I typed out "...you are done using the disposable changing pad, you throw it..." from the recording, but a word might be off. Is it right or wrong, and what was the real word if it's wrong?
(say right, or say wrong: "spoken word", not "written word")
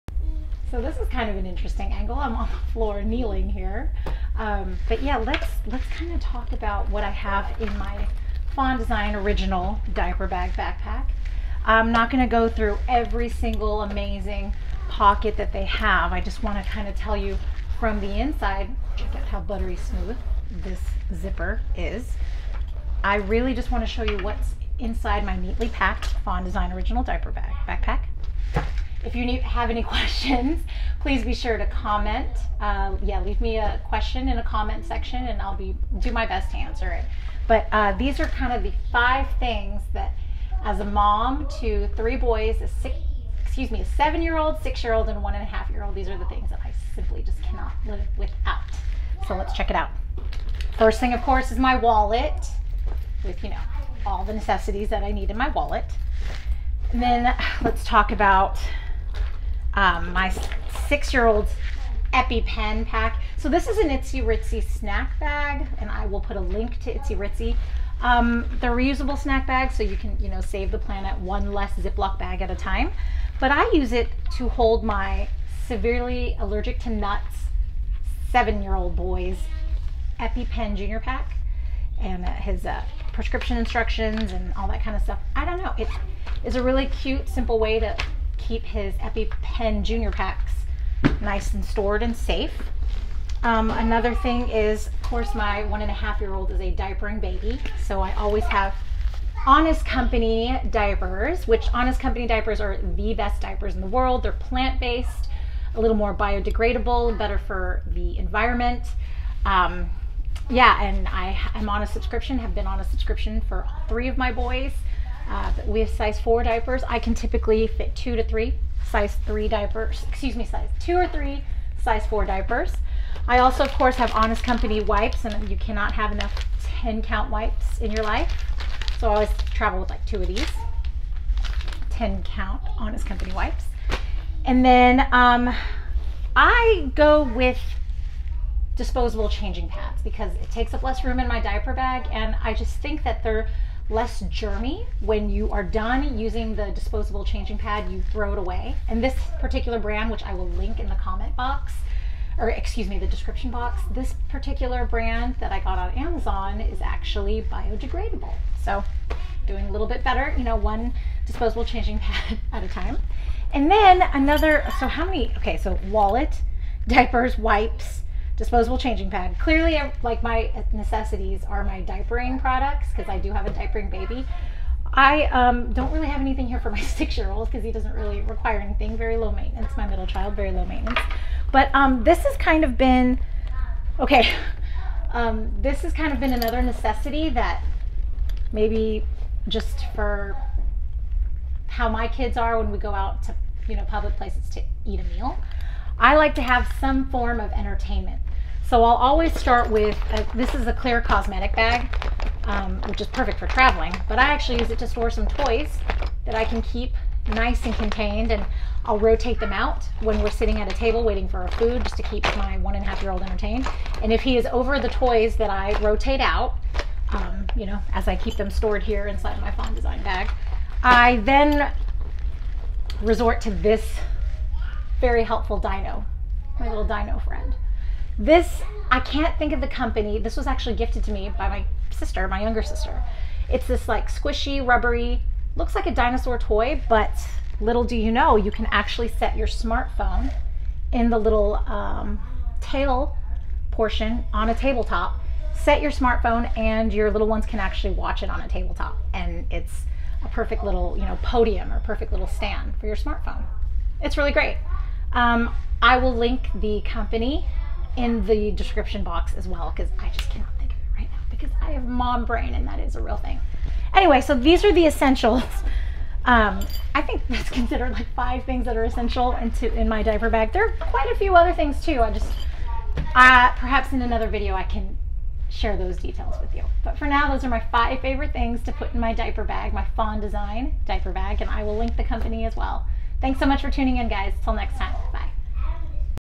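right.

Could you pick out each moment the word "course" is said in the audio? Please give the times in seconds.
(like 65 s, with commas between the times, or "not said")
51 s, 95 s, 123 s.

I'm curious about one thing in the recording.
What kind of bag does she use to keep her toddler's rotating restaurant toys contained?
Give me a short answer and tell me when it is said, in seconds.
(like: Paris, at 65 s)
Clear cosmetic bag, at 200 s.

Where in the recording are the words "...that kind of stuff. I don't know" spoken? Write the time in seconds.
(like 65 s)
84 s.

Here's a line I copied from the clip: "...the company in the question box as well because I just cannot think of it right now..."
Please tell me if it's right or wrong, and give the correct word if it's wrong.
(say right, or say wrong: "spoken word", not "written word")
wrong: "description", not "question".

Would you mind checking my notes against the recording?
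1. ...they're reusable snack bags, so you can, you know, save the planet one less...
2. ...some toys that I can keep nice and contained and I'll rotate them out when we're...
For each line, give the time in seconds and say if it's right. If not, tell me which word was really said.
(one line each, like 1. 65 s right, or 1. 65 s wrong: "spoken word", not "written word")
1. 68 s right
2. 205 s right.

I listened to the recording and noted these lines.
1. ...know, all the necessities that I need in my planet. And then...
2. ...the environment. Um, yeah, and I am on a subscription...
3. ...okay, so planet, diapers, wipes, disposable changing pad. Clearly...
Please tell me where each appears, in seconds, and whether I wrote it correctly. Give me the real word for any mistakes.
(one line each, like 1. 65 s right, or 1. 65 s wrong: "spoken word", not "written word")
1. 53 s wrong: "wallet", not "planet"
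2. 107 s right
3. 165 s wrong: "wallet", not "planet".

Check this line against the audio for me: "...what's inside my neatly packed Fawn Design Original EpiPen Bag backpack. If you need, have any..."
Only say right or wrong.
wrong.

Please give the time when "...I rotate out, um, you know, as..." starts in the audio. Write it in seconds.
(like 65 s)
215 s.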